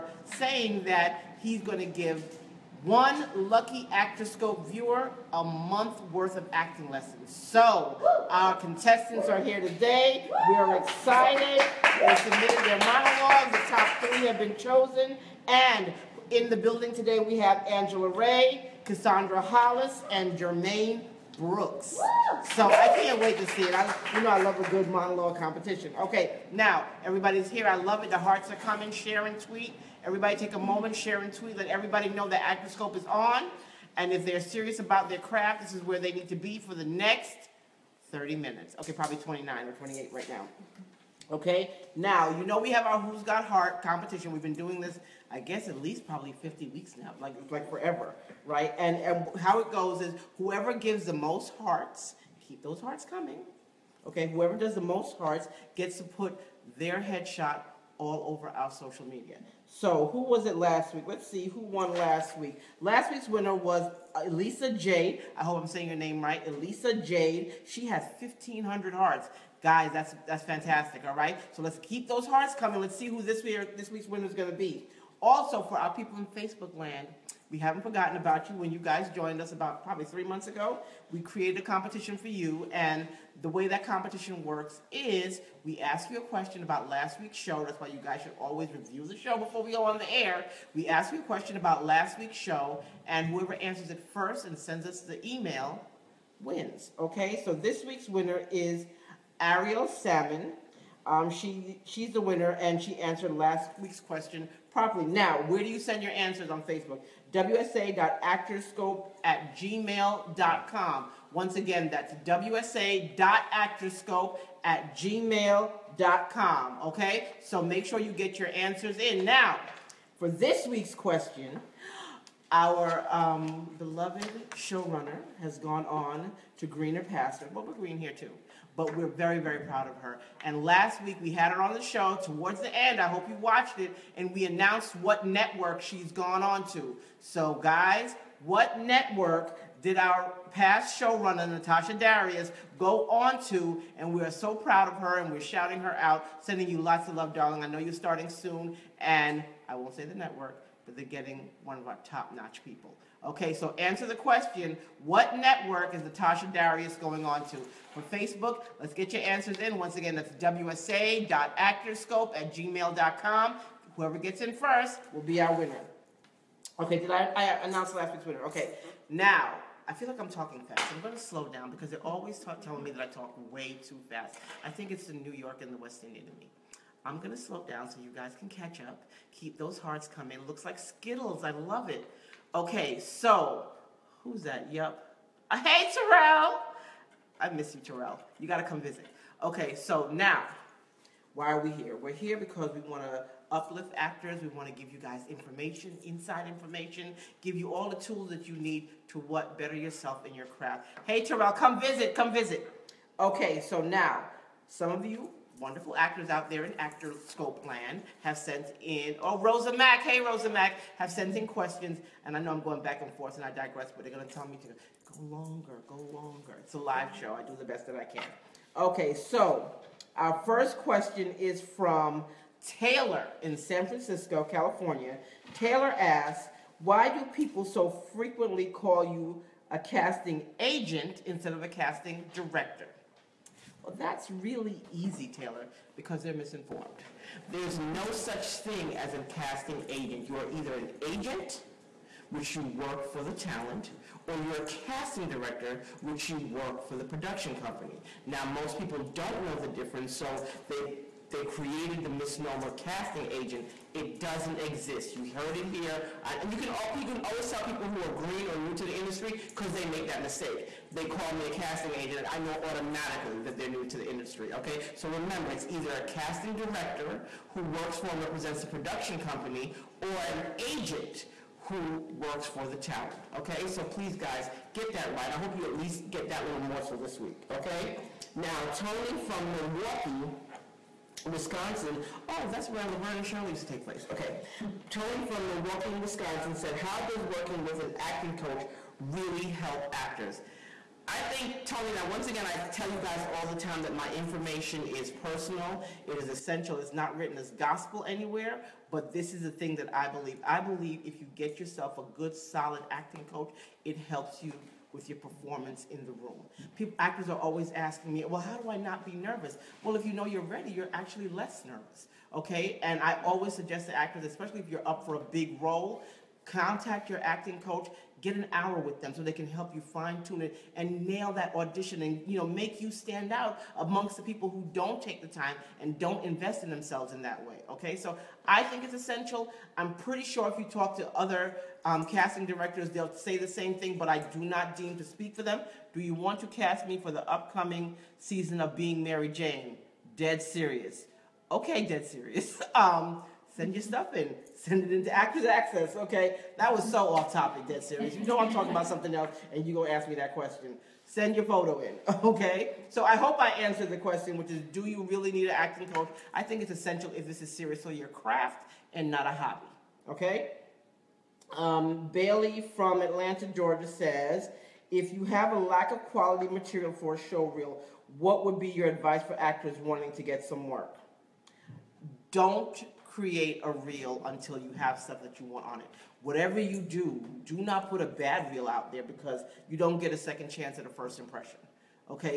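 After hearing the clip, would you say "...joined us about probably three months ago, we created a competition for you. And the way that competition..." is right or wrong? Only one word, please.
right.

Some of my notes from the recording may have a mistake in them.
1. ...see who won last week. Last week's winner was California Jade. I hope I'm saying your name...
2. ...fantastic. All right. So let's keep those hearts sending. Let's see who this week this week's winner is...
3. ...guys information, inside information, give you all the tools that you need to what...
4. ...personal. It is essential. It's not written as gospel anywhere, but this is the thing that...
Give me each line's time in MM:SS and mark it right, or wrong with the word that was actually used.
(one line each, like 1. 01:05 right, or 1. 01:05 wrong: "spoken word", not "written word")
1. 01:01 wrong: "Elisa", not "California"
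2. 01:10 wrong: "coming", not "sending"
3. 03:14 right
4. 04:55 right.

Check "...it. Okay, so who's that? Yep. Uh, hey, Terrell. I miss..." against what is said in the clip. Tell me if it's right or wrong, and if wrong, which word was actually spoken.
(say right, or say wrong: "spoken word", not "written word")
right.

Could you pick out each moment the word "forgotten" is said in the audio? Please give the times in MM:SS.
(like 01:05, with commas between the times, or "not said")
01:17.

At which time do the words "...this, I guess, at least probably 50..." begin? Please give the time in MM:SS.
00:44.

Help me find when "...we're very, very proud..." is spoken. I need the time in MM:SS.
02:08.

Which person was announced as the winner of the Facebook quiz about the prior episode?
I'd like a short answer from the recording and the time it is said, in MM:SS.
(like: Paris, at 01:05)
Ariel Salmon, at 01:39.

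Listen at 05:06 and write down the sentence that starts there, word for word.
People, actors are always asking me, well, how do I not be nervous?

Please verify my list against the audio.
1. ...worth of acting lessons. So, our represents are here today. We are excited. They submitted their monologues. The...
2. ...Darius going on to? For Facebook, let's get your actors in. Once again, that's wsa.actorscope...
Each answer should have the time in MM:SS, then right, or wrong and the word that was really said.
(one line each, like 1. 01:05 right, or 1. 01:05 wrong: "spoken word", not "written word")
1. 00:06 wrong: "contestants", not "represents"
2. 02:36 wrong: "answers", not "actors".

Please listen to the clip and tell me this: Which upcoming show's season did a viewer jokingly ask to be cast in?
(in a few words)
Being Mary Jane.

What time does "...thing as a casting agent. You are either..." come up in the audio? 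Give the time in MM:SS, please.
03:58.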